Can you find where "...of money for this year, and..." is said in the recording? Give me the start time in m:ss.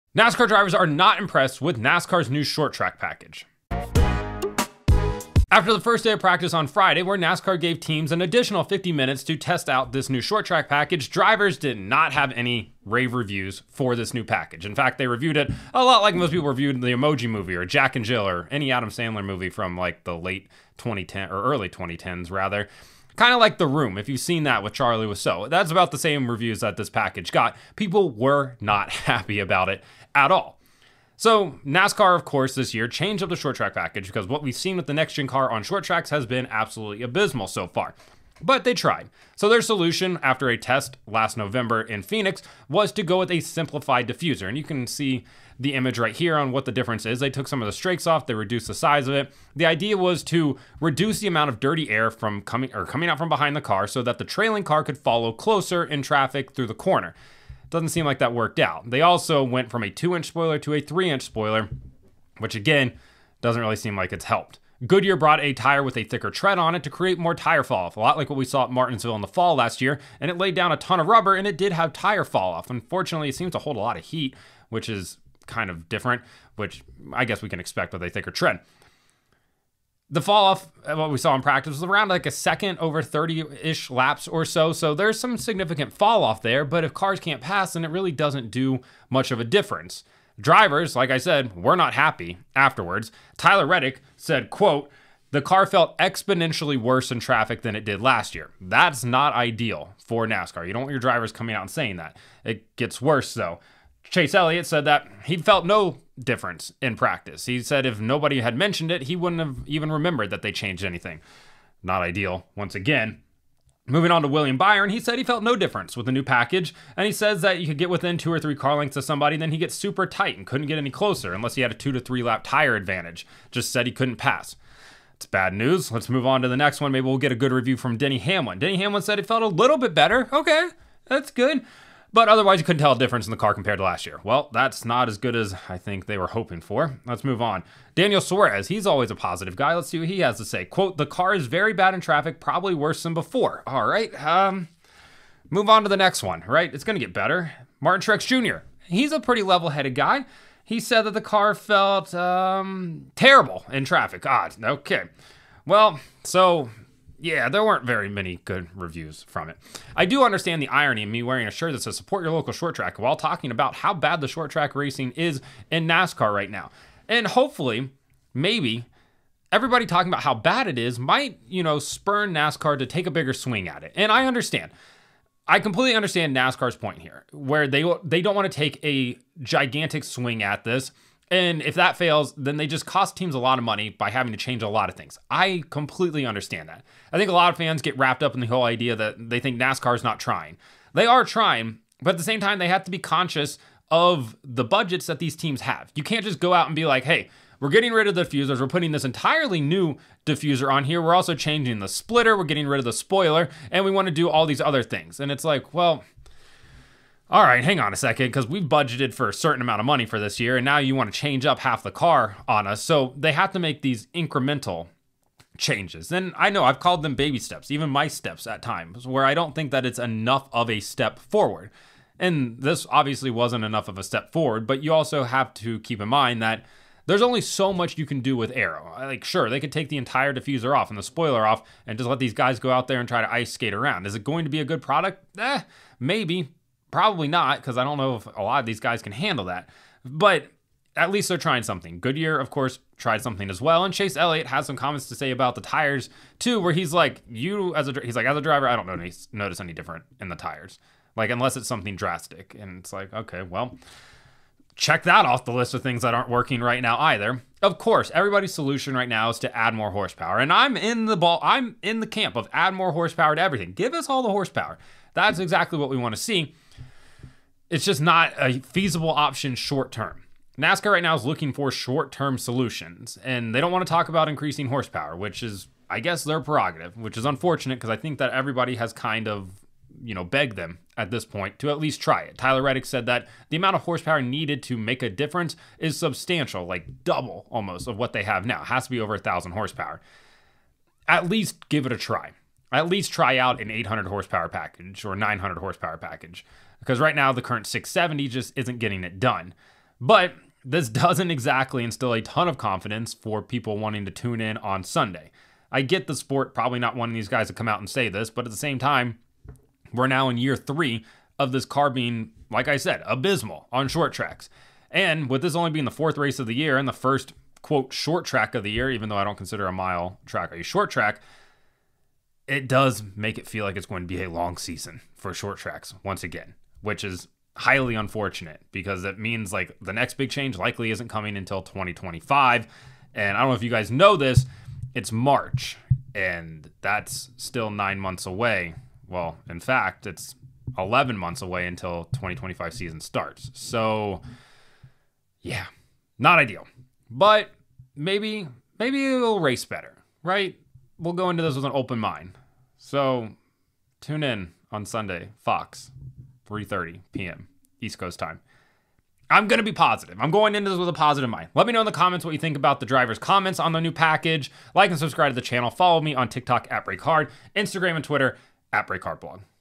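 3:29.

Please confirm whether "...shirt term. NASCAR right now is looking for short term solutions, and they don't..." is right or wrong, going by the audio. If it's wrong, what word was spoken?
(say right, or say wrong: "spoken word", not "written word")
wrong: "short", not "shirt".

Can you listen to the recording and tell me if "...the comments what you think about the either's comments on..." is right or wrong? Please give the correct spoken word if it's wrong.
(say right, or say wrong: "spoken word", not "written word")
wrong: "driver", not "either".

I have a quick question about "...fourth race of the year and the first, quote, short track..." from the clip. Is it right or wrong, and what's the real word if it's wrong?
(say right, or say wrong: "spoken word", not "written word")
right.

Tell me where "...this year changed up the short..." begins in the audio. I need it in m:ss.
0:32.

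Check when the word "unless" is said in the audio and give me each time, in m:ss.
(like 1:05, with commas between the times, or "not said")
2:01, 4:11.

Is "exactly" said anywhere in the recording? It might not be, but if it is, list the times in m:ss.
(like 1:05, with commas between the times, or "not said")
4:25, 5:01.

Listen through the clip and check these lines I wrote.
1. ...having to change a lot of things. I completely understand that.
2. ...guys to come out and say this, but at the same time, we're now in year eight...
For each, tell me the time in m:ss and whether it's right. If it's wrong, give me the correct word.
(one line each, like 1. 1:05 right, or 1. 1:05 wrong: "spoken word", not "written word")
1. 3:04 right
2. 5:07 wrong: "three", not "eight".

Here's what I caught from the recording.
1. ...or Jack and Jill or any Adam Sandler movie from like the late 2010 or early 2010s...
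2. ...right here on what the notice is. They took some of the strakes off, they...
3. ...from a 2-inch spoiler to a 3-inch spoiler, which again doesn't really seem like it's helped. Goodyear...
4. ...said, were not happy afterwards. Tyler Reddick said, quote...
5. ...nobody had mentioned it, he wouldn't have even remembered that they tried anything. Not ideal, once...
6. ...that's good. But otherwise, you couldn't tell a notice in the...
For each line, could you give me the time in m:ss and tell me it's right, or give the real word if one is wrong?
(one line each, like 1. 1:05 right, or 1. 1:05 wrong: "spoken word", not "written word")
1. 0:17 right
2. 0:45 wrong: "difference", not "notice"
3. 0:59 right
4. 1:31 right
5. 1:48 wrong: "changed", not "tried"
6. 2:11 wrong: "difference", not "notice".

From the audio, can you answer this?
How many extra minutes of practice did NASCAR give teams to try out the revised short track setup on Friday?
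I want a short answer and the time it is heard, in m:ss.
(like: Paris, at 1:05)
50, at 0:08.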